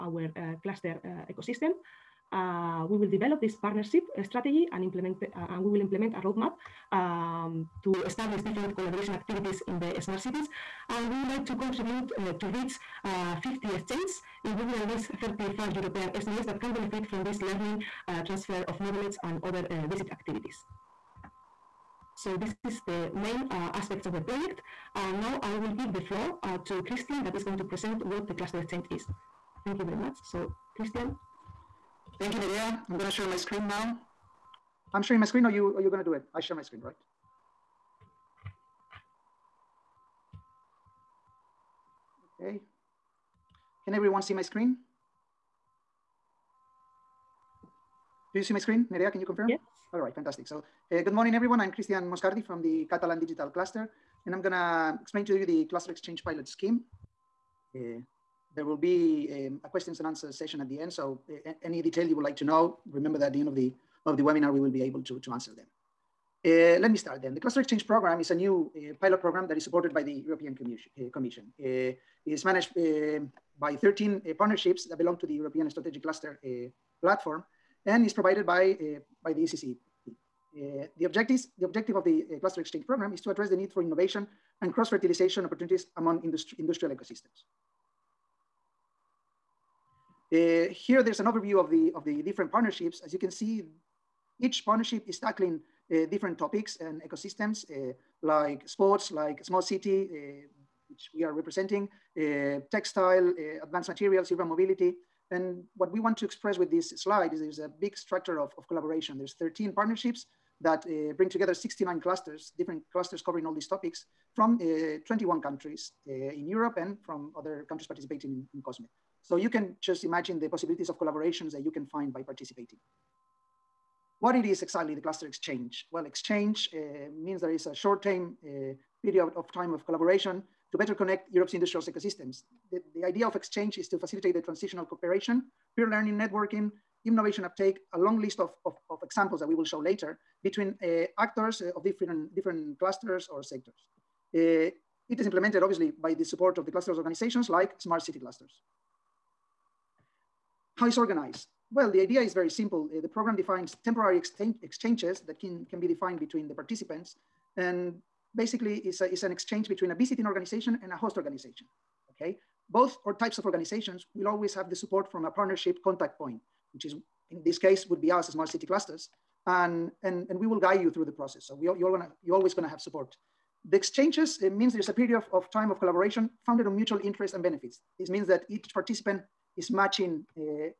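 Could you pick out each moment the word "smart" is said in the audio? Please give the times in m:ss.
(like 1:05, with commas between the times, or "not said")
0:09, 1:39, 2:27, 2:48.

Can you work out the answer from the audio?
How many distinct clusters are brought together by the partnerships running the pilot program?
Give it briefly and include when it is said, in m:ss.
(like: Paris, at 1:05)
69, at 1:51.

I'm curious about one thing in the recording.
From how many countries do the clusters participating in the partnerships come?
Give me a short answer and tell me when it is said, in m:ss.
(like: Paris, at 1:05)
21, at 1:55.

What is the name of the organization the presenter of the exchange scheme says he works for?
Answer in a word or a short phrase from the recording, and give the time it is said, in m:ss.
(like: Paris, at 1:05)
Catalan Digital Cluster, at 0:52.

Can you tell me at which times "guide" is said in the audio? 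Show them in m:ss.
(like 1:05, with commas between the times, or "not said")
2:50.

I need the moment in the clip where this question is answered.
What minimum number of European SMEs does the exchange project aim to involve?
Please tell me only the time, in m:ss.
0:15.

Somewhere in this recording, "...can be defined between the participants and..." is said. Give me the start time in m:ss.
2:35.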